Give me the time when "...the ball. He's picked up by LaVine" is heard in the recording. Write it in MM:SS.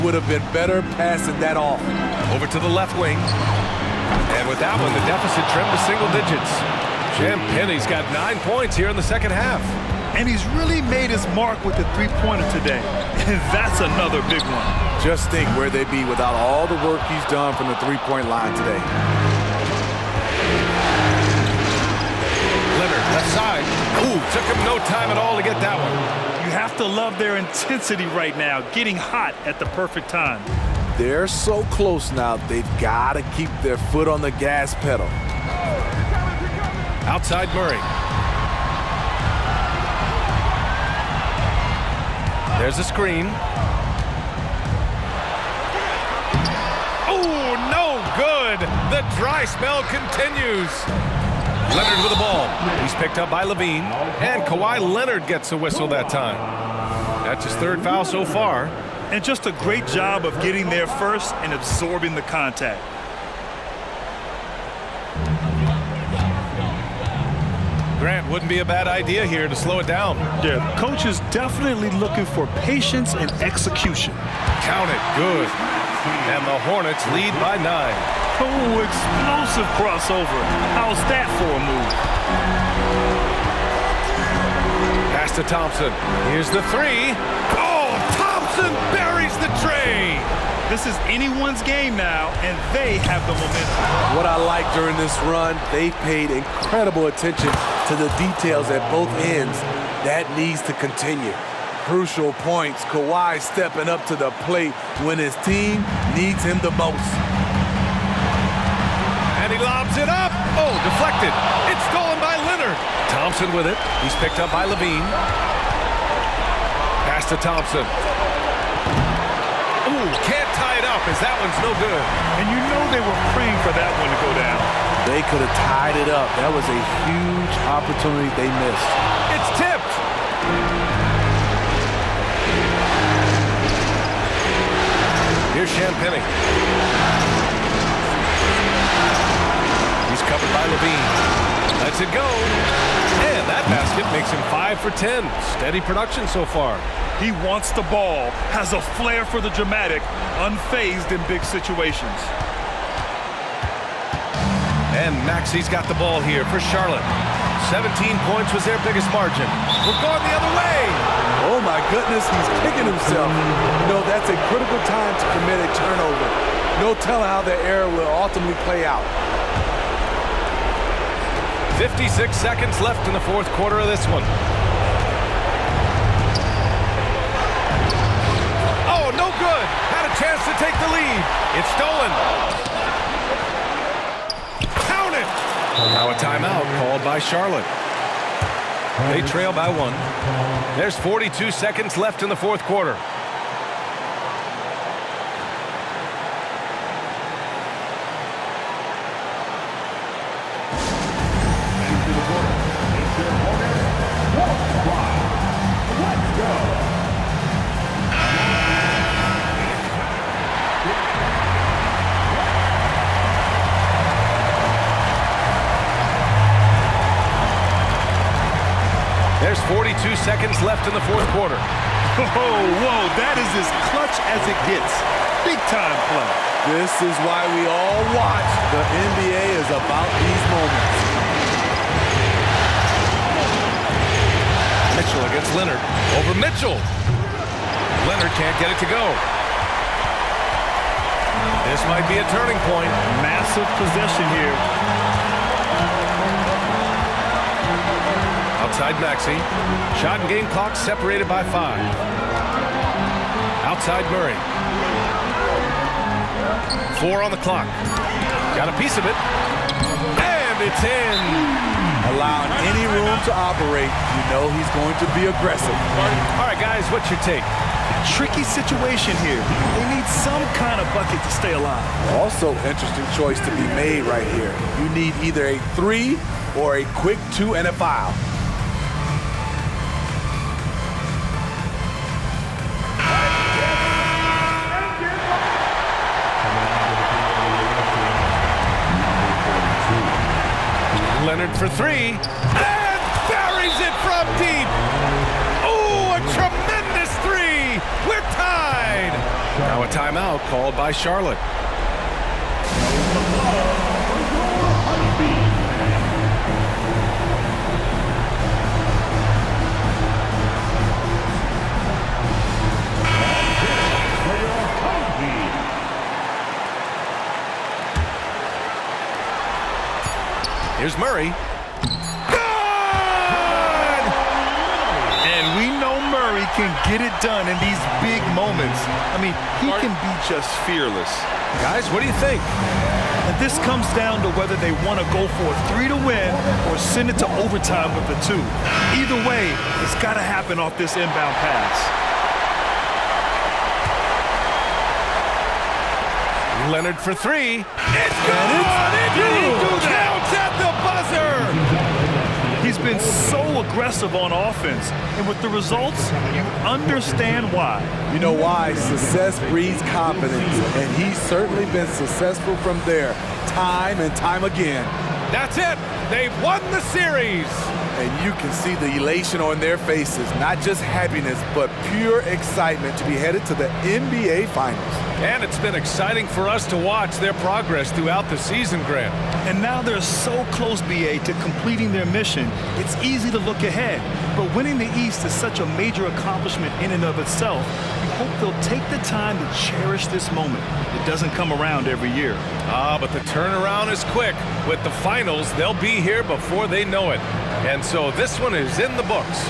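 00:52.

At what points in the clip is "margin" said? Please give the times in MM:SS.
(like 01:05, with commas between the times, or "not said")
02:39.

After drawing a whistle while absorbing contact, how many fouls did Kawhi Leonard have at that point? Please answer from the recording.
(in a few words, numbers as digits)
3.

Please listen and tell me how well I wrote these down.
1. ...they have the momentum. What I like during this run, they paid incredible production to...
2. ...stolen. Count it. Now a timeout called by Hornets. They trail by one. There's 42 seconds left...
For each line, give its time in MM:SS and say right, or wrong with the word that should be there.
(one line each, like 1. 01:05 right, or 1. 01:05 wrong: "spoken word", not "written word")
1. 01:32 wrong: "attention", not "production"
2. 03:01 wrong: "Charlotte", not "Hornets".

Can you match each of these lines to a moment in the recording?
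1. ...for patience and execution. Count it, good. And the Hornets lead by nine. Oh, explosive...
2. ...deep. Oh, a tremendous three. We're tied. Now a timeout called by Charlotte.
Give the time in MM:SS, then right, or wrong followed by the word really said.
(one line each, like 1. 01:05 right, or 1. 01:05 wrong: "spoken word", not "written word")
1. 01:12 right
2. 04:54 right.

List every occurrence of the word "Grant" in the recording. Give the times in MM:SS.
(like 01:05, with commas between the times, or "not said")
01:07, 06:18.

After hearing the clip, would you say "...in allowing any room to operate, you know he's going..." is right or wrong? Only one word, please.
right.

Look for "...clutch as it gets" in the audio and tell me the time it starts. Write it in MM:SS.
03:43.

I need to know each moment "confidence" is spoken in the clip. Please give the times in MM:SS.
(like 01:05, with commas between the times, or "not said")
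05:59.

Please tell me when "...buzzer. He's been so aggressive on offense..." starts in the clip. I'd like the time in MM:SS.
05:52.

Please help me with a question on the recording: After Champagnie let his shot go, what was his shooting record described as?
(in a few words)
5 for 10.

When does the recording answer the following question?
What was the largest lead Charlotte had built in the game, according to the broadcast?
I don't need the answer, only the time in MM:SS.
02:37.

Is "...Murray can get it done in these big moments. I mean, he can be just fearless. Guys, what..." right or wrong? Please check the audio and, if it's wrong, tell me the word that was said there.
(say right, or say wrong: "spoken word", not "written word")
right.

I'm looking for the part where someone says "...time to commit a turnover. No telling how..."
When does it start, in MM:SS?
02:44.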